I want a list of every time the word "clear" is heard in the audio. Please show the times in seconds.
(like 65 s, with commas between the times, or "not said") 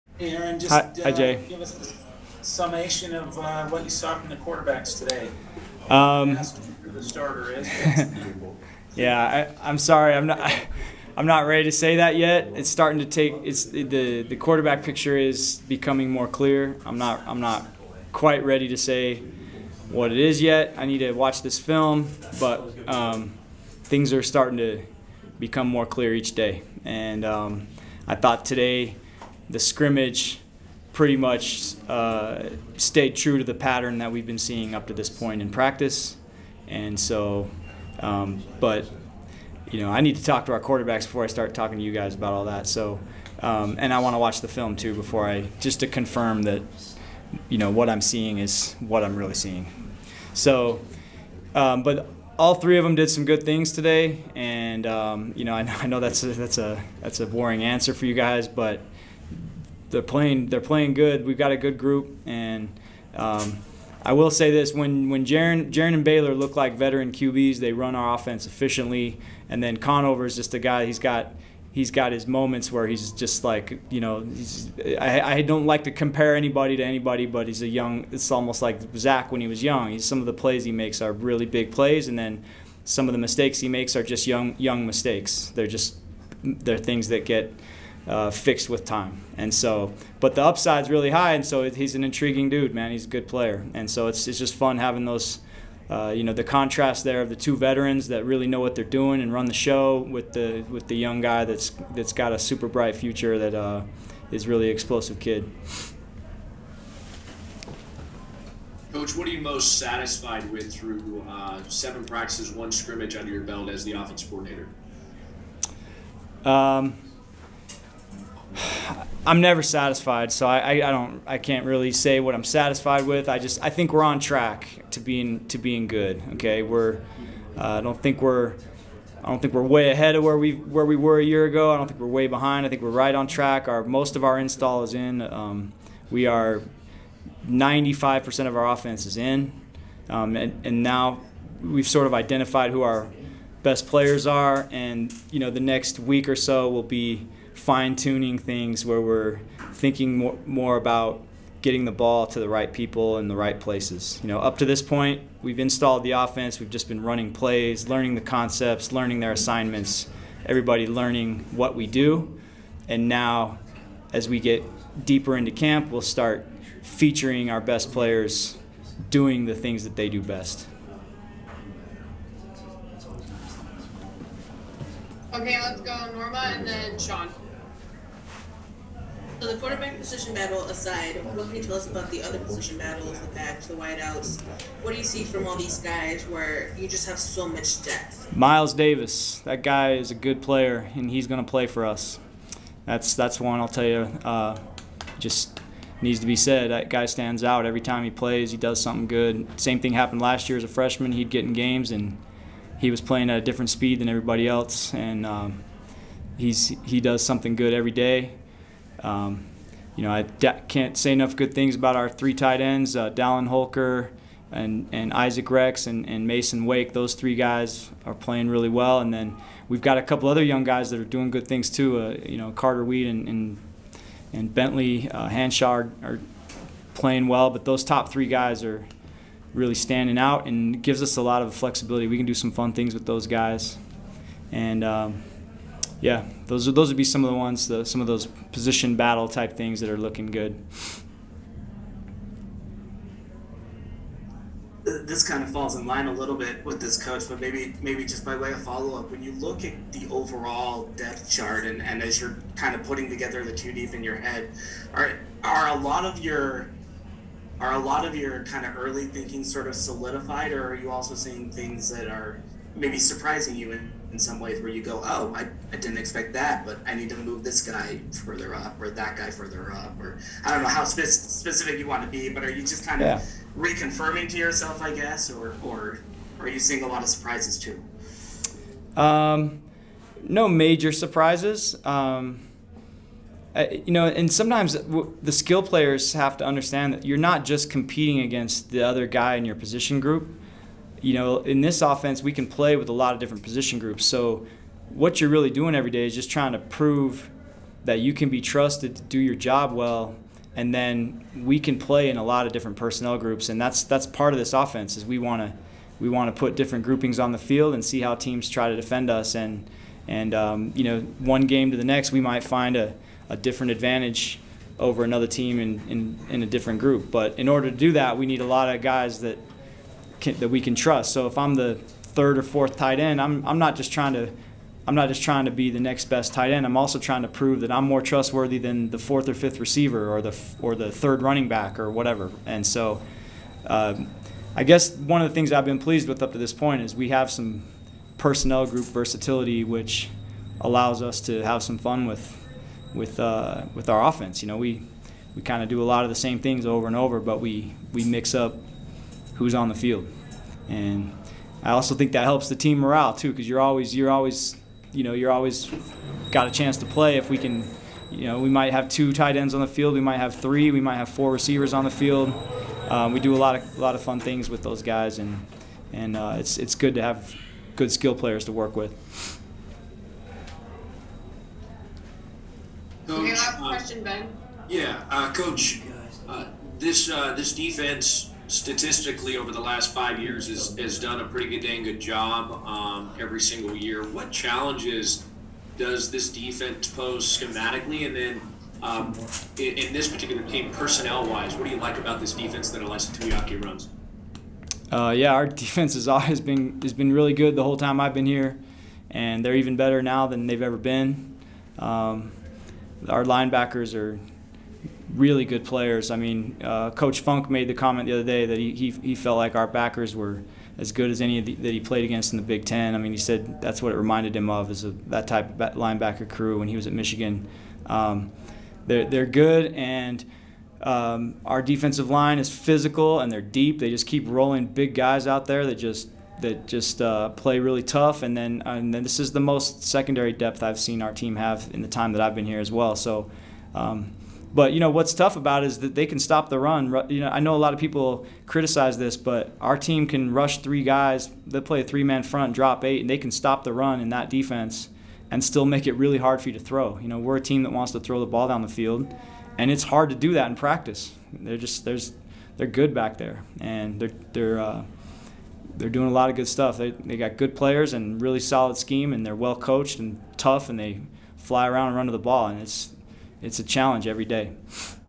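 16 s, 25 s.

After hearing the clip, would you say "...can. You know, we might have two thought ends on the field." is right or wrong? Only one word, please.
wrong.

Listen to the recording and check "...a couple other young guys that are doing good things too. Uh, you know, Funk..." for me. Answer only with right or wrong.
wrong.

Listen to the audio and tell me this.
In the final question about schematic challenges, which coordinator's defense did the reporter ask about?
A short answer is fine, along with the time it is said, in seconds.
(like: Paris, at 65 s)
Ilaisa Tuiaki, at 392 s.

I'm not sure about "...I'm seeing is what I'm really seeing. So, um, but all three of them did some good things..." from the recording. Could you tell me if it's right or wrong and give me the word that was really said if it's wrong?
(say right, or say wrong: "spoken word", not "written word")
right.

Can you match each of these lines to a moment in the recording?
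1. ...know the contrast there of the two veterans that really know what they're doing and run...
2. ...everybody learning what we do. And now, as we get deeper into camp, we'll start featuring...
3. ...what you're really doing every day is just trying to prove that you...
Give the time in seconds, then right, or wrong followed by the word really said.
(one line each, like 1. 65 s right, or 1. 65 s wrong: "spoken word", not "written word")
1. 96 s right
2. 160 s right
3. 294 s right.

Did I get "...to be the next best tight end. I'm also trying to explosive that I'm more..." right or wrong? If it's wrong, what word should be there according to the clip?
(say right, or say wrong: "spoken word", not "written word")
wrong: "prove", not "explosive".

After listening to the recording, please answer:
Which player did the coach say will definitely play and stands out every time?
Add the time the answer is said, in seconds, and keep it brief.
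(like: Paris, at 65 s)
Miles Davis, at 188 s.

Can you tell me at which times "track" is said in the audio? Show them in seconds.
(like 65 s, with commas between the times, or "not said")
124 s, 133 s.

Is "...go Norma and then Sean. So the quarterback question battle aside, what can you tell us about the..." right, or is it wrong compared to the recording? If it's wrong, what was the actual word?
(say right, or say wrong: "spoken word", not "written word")
wrong: "position", not "question".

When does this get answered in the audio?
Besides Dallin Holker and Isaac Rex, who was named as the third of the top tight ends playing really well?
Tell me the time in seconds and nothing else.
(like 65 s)
216 s.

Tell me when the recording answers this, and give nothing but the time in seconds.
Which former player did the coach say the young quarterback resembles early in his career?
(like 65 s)
78 s.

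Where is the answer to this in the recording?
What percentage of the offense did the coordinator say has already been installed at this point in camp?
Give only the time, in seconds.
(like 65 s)
137 s.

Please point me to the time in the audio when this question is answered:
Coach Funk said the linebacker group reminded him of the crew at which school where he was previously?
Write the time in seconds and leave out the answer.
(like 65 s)
416 s.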